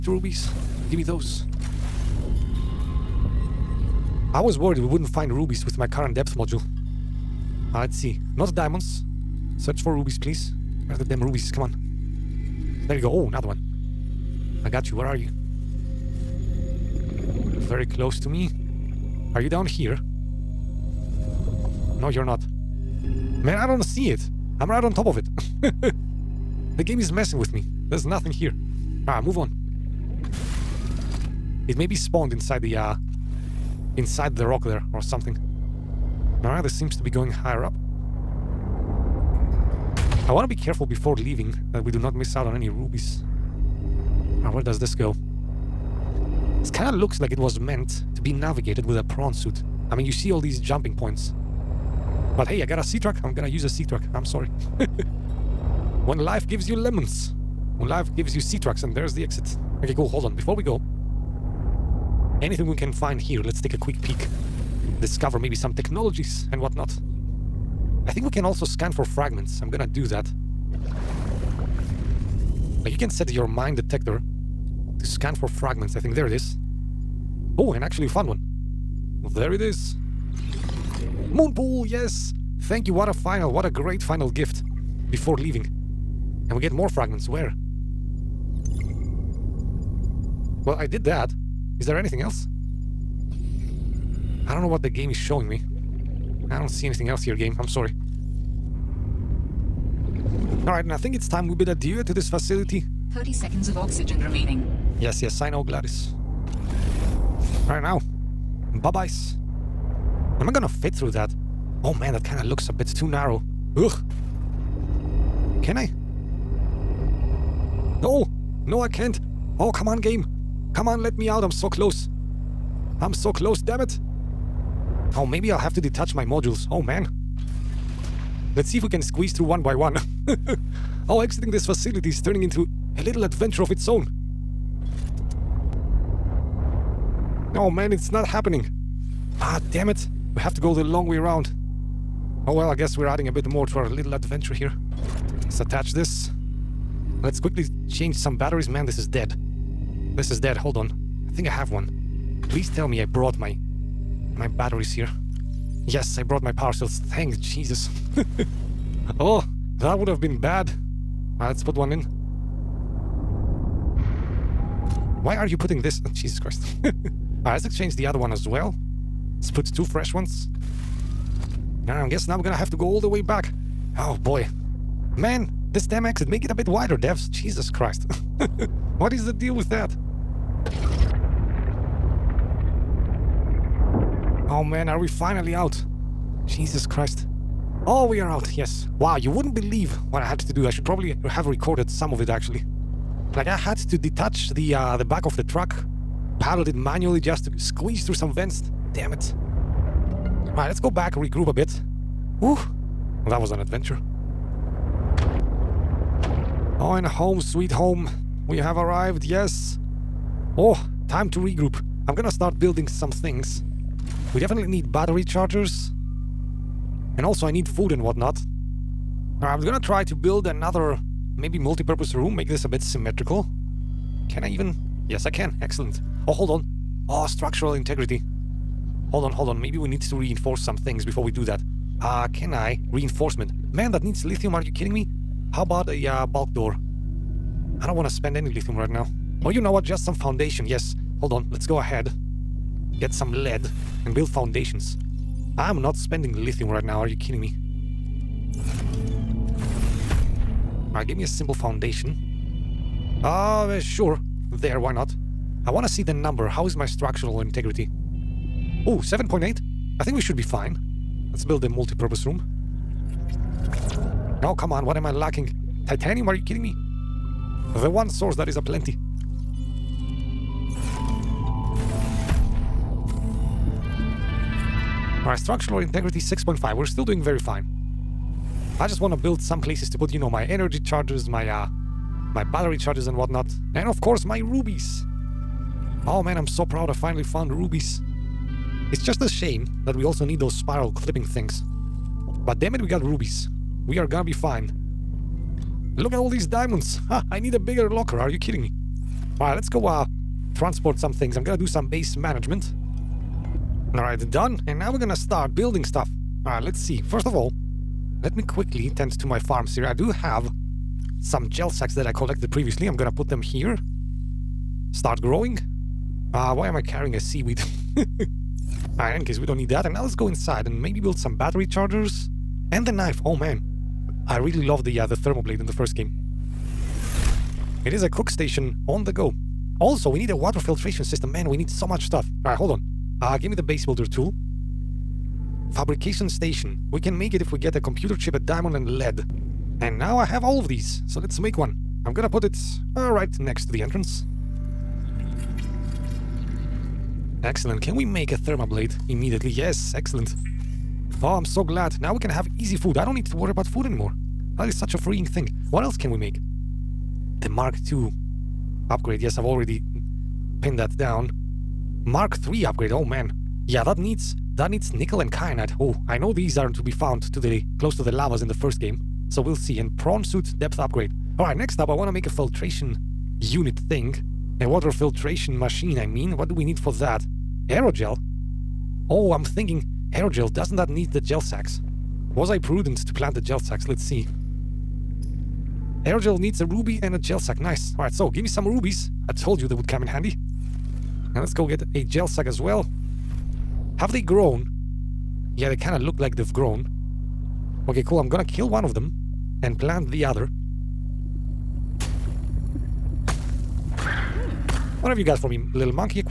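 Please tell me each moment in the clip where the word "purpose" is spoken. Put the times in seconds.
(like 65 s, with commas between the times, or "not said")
221 s, 261 s.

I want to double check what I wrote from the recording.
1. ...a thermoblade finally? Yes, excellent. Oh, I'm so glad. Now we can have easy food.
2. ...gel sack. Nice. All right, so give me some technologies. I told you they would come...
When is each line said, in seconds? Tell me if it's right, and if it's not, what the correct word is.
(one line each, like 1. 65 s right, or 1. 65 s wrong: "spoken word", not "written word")
1. 348 s wrong: "immediately", not "finally"
2. 387 s wrong: "rubies", not "technologies".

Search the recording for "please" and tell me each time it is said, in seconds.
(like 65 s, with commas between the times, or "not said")
10 s, 152 s.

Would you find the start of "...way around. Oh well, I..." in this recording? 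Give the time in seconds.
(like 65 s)
141 s.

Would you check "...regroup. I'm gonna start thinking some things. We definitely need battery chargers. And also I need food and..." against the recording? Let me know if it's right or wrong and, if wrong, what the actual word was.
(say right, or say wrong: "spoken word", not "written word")
wrong: "building", not "thinking".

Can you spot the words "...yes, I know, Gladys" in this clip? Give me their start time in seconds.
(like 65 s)
105 s.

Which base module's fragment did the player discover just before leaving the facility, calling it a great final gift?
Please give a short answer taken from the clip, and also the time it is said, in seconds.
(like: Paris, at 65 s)
Moonpool, at 81 s.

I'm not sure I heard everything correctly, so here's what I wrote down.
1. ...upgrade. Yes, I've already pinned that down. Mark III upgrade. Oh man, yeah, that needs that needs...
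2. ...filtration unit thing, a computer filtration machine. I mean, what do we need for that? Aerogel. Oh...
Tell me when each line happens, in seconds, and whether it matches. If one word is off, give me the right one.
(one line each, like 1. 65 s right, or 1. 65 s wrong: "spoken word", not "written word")
1. 358 s right
2. 372 s wrong: "water", not "computer".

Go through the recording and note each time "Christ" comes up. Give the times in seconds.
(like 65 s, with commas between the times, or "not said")
166 s, 177 s, 186 s.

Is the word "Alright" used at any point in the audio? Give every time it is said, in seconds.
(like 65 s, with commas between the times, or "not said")
36 s, 100 s, 200 s, 250 s, 275 s, 318 s, 332 s.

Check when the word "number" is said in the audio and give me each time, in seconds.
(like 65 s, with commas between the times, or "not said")
256 s.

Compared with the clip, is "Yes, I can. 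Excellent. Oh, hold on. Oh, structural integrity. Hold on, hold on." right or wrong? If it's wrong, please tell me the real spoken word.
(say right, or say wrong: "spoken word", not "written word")
right.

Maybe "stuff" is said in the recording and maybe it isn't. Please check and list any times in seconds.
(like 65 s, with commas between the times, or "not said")
305 s, 332 s.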